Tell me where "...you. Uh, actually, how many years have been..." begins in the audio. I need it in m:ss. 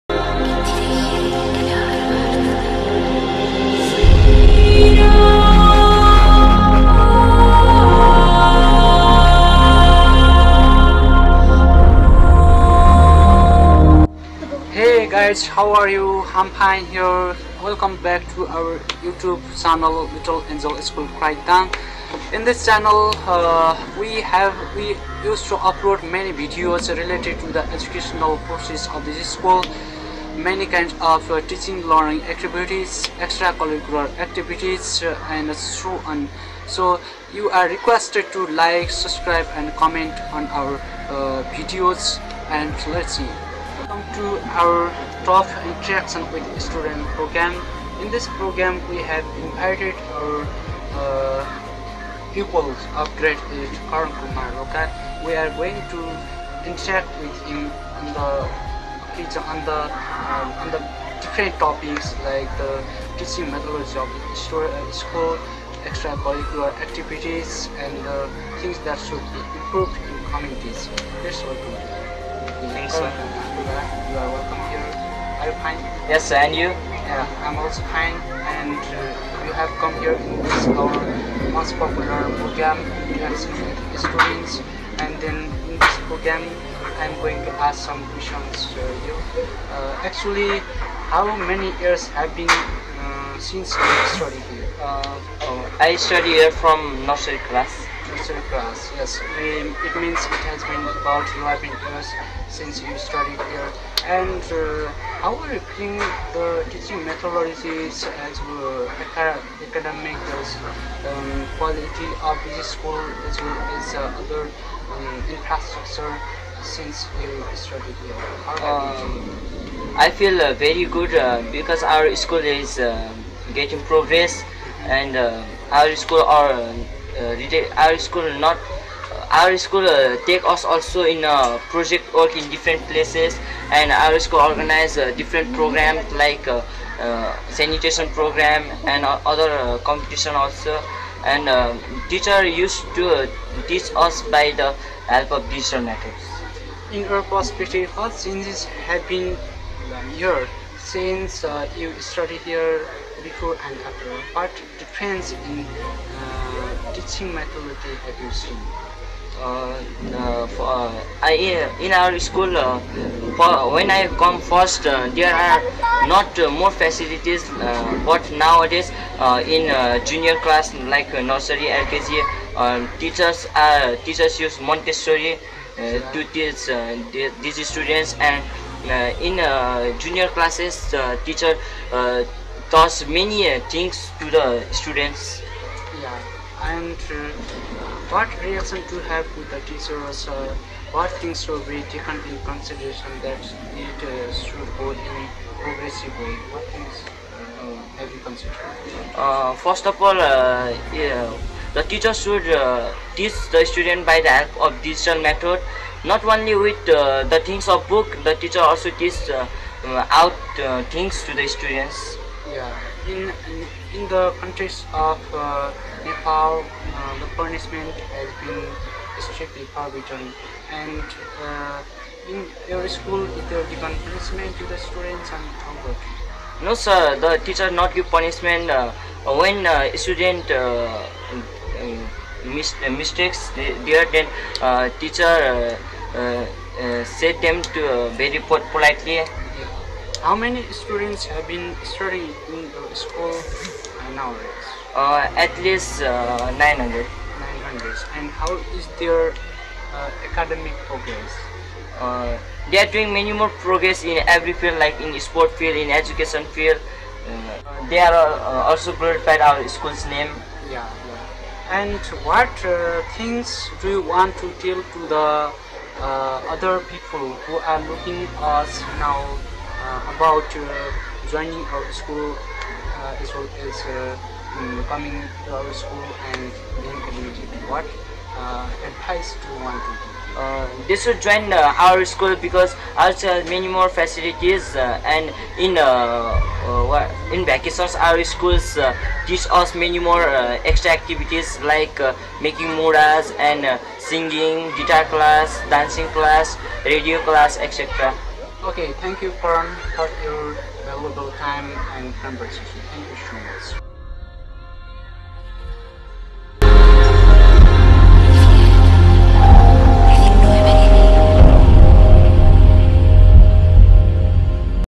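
1:29.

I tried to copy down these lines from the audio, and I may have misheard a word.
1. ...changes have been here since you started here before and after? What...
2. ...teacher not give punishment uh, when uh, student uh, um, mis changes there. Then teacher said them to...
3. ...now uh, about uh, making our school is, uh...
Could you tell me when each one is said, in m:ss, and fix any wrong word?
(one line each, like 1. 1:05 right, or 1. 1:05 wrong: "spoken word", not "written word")
1. 2:28 right
2. 3:47 wrong: "mistakes", not "changes"
3. 4:29 wrong: "joining", not "making".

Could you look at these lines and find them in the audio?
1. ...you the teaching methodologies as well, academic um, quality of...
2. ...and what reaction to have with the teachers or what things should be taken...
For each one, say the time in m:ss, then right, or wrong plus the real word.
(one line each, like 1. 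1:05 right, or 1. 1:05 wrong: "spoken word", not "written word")
1. 1:45 right
2. 3:06 right.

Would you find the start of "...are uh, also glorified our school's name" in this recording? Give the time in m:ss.
4:17.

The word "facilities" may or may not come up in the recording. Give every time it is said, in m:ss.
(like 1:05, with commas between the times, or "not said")
2:46, 4:43.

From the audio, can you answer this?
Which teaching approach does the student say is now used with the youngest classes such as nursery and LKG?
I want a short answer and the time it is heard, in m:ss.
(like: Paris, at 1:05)
Montessori, at 2:54.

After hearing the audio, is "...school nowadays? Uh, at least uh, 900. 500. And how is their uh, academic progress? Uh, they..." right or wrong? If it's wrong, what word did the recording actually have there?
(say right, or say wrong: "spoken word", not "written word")
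wrong: "900", not "500".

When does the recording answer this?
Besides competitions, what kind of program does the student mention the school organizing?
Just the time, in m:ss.
2:17.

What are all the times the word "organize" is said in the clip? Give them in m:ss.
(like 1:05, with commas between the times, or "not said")
2:14.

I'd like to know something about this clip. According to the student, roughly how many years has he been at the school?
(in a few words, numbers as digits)
11.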